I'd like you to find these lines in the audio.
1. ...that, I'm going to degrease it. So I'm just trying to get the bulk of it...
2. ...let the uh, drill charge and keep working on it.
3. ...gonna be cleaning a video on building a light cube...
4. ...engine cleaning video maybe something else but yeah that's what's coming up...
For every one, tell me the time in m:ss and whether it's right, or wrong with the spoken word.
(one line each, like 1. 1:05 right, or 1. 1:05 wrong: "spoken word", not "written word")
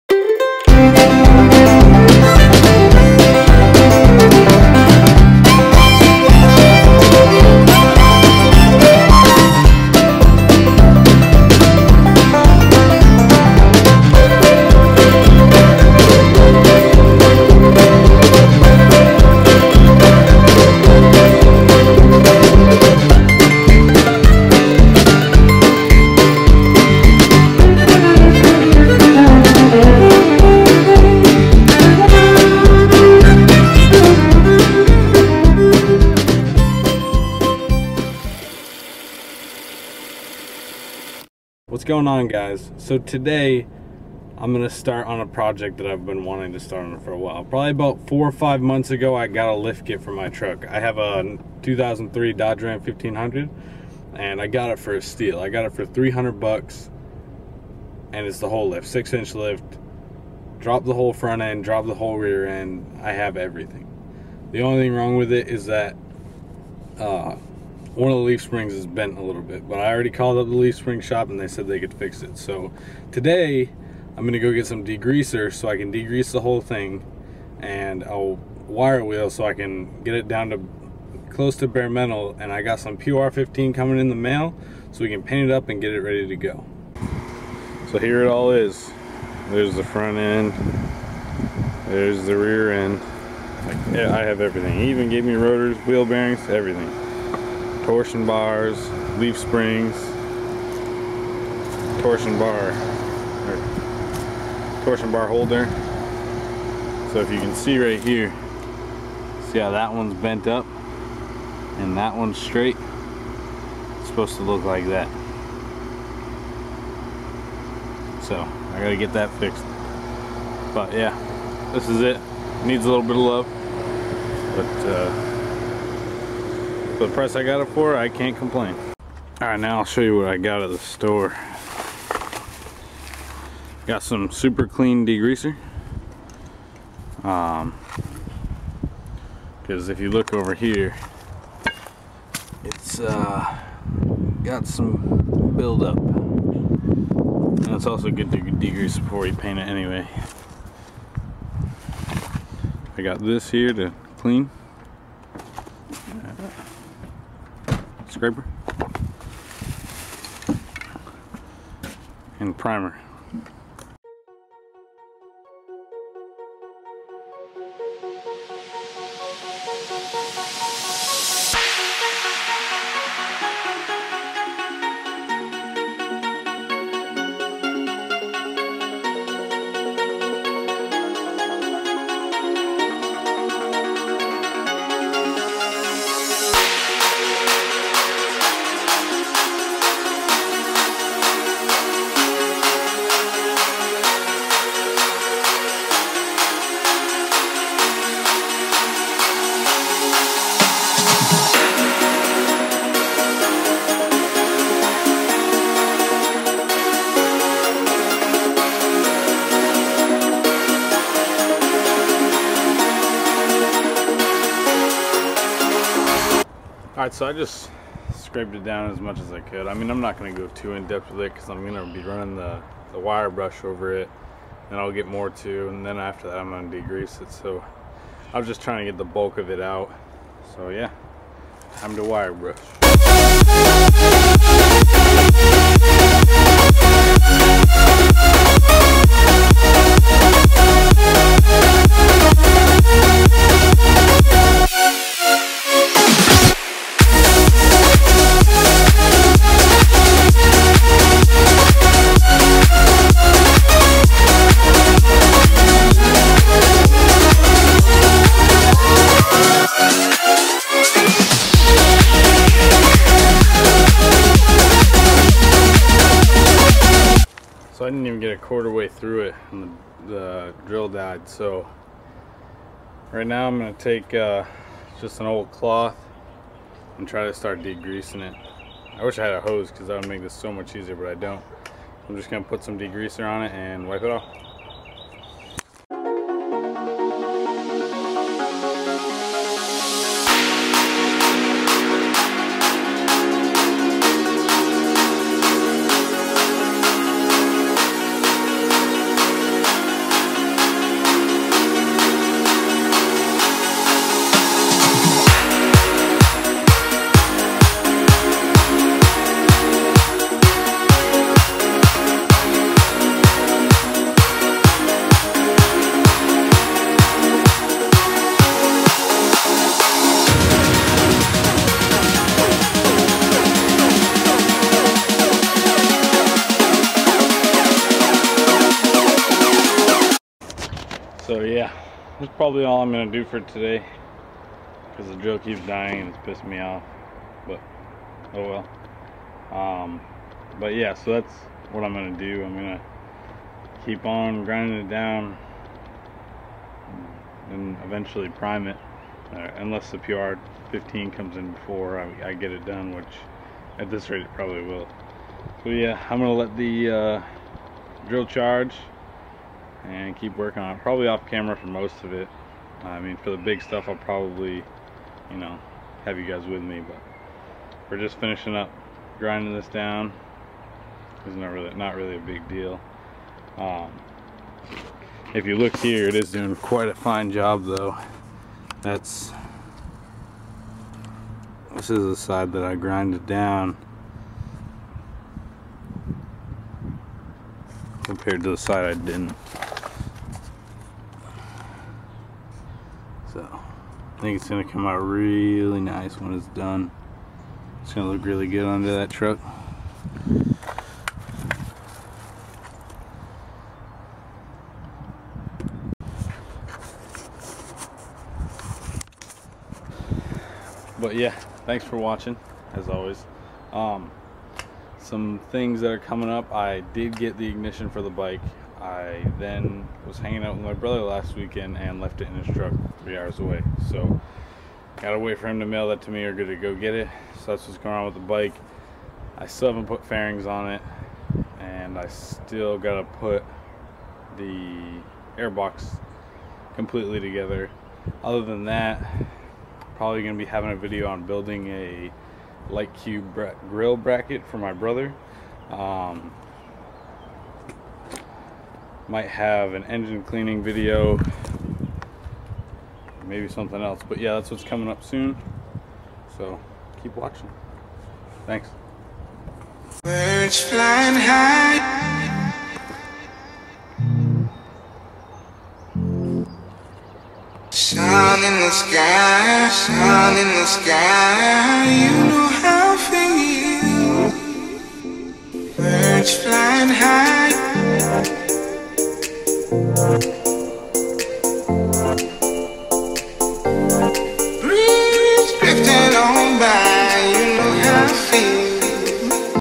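1. 3:46 right
2. 5:56 right
3. 7:20 wrong: "having", not "cleaning"
4. 7:29 right.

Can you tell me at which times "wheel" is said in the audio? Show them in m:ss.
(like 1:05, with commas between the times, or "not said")
1:19, 1:35.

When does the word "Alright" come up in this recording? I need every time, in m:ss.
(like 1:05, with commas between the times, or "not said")
3:37.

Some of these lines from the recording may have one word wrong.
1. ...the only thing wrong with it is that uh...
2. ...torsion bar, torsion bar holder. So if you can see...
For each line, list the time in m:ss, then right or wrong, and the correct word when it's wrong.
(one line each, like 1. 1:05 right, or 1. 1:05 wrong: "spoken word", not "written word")
1. 1:04 right
2. 1:42 right.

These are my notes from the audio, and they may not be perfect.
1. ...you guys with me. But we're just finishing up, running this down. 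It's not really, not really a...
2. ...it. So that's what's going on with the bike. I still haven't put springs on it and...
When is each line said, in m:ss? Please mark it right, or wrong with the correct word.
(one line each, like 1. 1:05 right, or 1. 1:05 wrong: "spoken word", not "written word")
1. 6:06 wrong: "grinding", not "running"
2. 7:06 wrong: "fairings", not "springs".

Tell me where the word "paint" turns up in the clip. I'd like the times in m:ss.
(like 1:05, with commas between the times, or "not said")
1:25, 2:29.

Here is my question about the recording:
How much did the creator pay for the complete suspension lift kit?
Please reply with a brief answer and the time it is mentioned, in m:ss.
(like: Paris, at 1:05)
$300, at 0:55.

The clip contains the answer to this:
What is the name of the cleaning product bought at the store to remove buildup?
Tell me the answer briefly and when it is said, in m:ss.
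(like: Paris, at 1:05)
Super Clean, at 2:14.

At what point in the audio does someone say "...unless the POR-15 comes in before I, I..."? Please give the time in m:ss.
5:49.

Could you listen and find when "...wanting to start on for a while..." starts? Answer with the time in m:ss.
0:46.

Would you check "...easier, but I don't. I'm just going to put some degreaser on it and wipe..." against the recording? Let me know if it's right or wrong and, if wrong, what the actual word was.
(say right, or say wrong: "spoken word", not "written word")
right.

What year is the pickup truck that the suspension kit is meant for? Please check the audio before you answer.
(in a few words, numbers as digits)
2003.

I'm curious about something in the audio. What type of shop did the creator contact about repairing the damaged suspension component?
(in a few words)
leaf spring shop.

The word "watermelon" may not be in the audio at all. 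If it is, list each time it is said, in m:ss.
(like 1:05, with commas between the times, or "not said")
not said.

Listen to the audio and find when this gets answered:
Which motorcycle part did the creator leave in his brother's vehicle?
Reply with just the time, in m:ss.
6:57.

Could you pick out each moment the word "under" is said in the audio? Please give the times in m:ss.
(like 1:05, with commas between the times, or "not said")
6:38.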